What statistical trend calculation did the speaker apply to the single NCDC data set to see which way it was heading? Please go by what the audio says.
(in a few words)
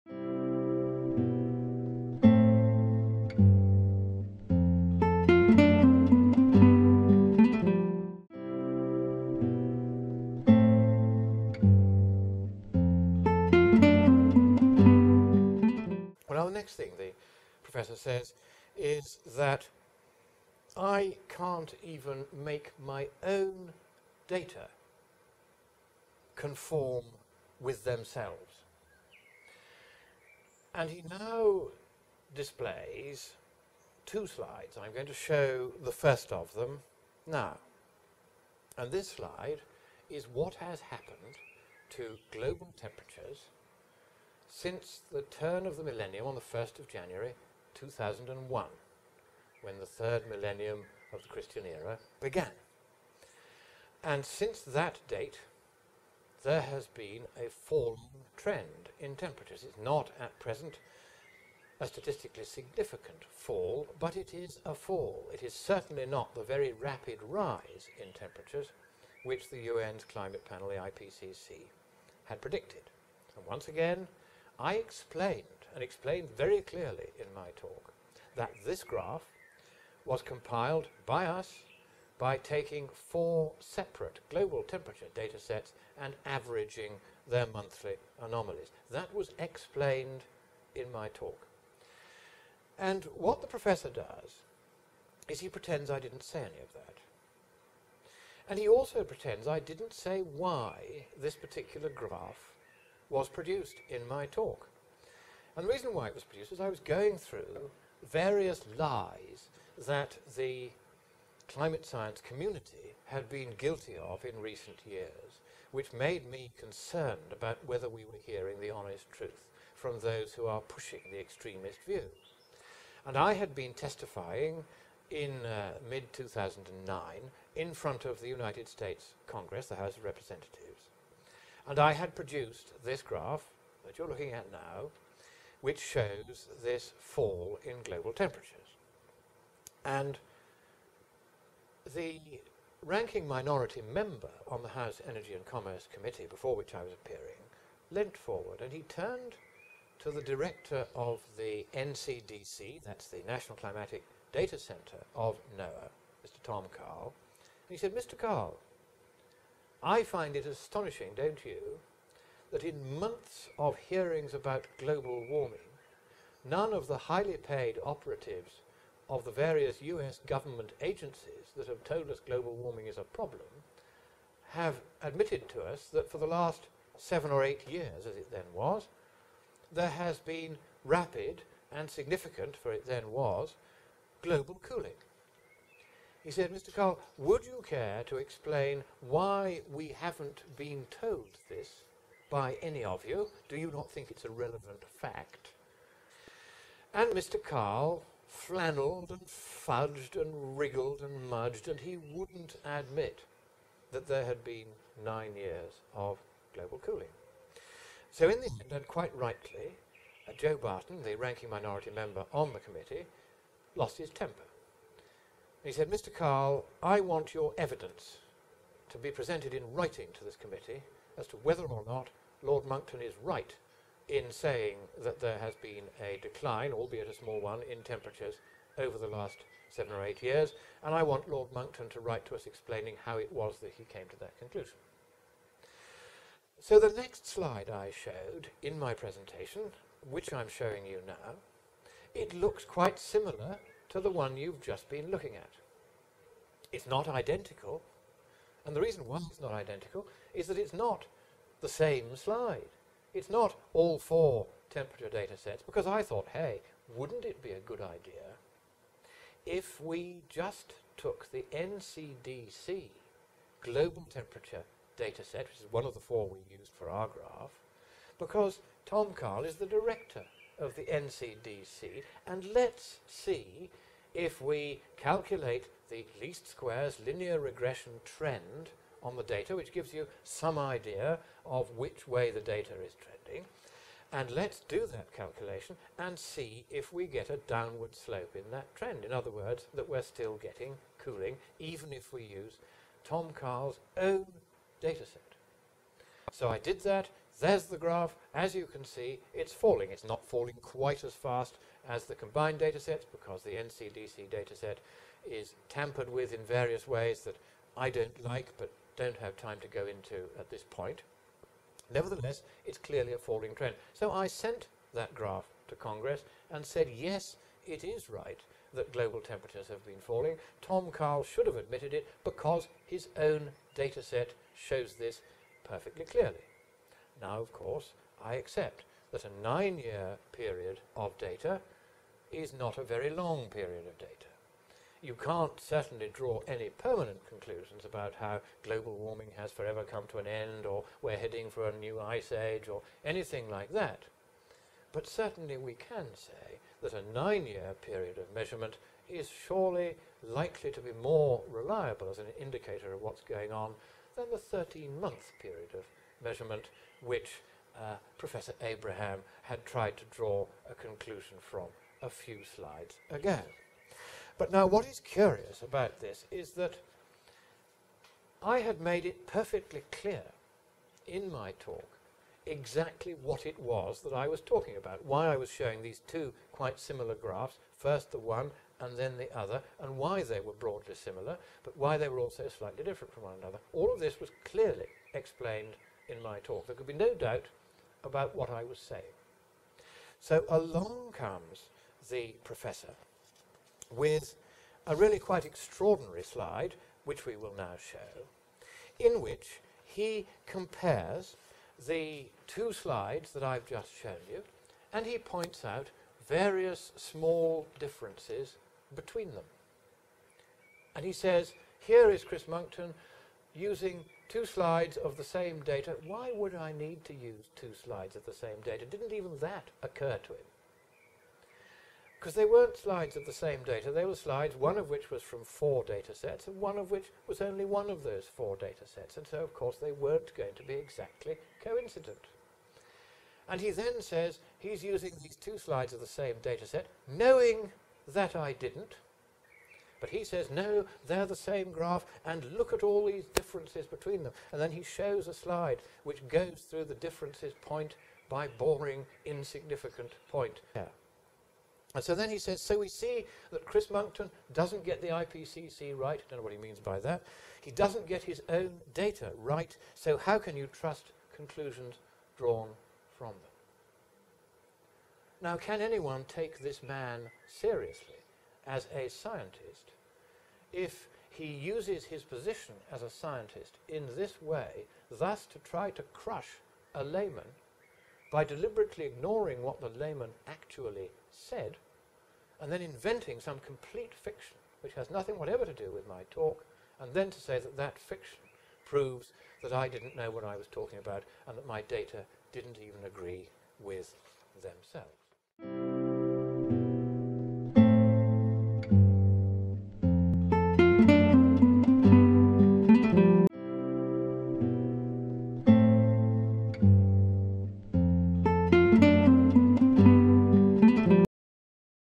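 least squares linear regression.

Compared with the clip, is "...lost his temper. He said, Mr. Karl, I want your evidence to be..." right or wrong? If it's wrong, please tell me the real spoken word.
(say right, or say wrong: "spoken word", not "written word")
right.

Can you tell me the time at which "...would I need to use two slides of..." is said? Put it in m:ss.
6:56.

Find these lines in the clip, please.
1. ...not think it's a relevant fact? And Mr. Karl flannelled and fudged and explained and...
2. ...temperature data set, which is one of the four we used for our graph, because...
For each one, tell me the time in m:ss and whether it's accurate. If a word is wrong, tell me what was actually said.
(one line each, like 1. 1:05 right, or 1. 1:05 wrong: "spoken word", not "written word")
1. 3:13 wrong: "wriggled", not "explained"
2. 4:24 right.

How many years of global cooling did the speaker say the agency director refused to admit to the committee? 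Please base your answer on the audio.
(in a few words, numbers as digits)
9.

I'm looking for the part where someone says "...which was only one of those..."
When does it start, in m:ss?
7:06.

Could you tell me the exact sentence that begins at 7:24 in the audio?
And then he shows a slide which goes through the differences point by boring insignificant point.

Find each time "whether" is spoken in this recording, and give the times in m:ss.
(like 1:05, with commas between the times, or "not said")
1:57, 3:41.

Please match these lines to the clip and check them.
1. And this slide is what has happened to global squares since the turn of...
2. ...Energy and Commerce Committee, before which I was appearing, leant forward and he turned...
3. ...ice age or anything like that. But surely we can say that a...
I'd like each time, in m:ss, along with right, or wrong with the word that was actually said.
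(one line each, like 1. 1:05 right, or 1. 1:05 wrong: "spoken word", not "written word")
1. 0:38 wrong: "temperatures", not "squares"
2. 2:25 right
3. 5:41 wrong: "certainly", not "surely".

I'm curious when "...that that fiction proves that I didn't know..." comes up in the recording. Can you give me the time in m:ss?
8:07.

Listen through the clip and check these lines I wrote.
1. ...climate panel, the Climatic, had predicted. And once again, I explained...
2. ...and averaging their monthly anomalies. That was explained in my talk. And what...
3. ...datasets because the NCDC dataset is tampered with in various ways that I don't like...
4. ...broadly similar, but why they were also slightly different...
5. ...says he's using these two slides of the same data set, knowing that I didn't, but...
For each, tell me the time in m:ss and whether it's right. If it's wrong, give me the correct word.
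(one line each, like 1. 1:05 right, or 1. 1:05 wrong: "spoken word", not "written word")
1. 1:10 wrong: "IPCC", not "Climatic"
2. 1:25 right
3. 5:02 right
4. 6:20 right
5. 7:14 right.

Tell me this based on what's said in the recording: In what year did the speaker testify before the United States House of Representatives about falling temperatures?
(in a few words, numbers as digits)
2009.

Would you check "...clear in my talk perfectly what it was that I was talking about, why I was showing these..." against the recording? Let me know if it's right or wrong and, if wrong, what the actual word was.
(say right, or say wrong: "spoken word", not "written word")
wrong: "exactly", not "perfectly".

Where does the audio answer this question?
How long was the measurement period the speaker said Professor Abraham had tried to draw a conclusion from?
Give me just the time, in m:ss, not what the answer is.
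5:54.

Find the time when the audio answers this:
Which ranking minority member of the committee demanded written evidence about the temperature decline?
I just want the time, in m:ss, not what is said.
3:30.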